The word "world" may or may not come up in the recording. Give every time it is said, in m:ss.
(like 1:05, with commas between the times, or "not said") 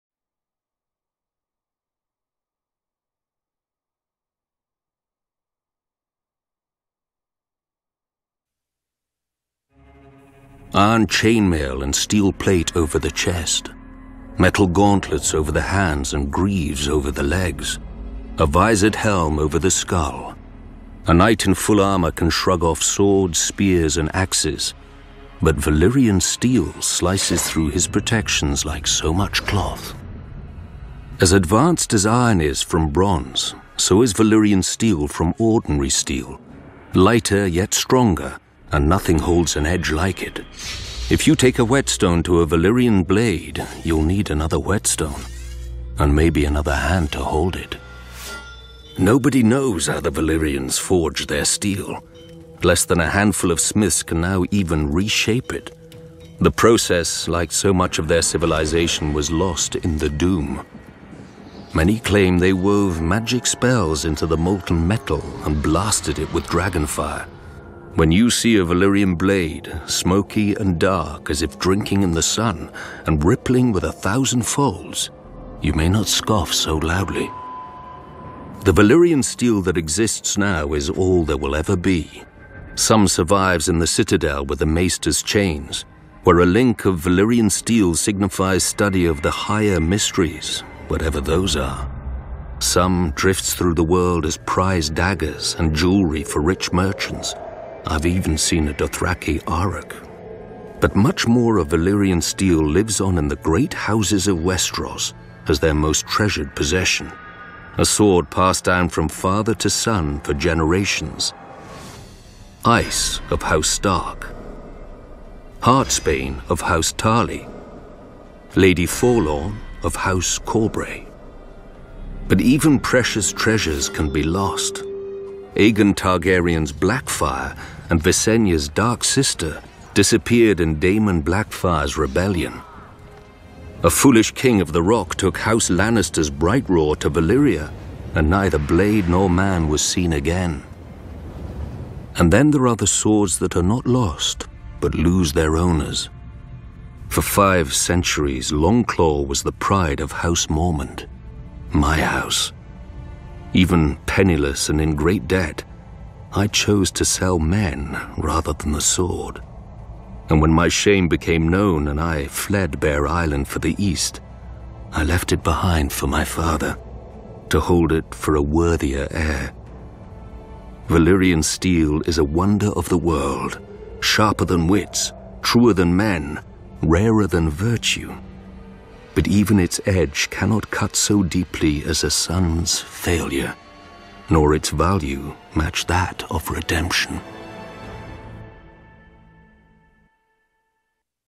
1:33, 2:52.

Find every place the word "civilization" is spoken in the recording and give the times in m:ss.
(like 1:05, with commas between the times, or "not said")
0:58.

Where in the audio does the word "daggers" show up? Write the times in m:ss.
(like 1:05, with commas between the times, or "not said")
1:34.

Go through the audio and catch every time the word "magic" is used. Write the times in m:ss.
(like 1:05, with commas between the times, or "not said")
1:03.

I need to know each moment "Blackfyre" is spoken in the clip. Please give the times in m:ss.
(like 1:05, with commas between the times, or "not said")
2:06, 2:11.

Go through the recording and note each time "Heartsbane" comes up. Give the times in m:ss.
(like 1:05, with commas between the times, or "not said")
1:55.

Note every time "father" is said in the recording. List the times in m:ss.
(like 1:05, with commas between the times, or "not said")
1:49, 2:46.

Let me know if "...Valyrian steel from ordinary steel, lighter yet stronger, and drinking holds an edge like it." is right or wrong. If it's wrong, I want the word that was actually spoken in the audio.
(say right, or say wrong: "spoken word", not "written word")
wrong: "nothing", not "drinking".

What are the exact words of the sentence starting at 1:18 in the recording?
The Valyrian steel that exists now is all there will ever be.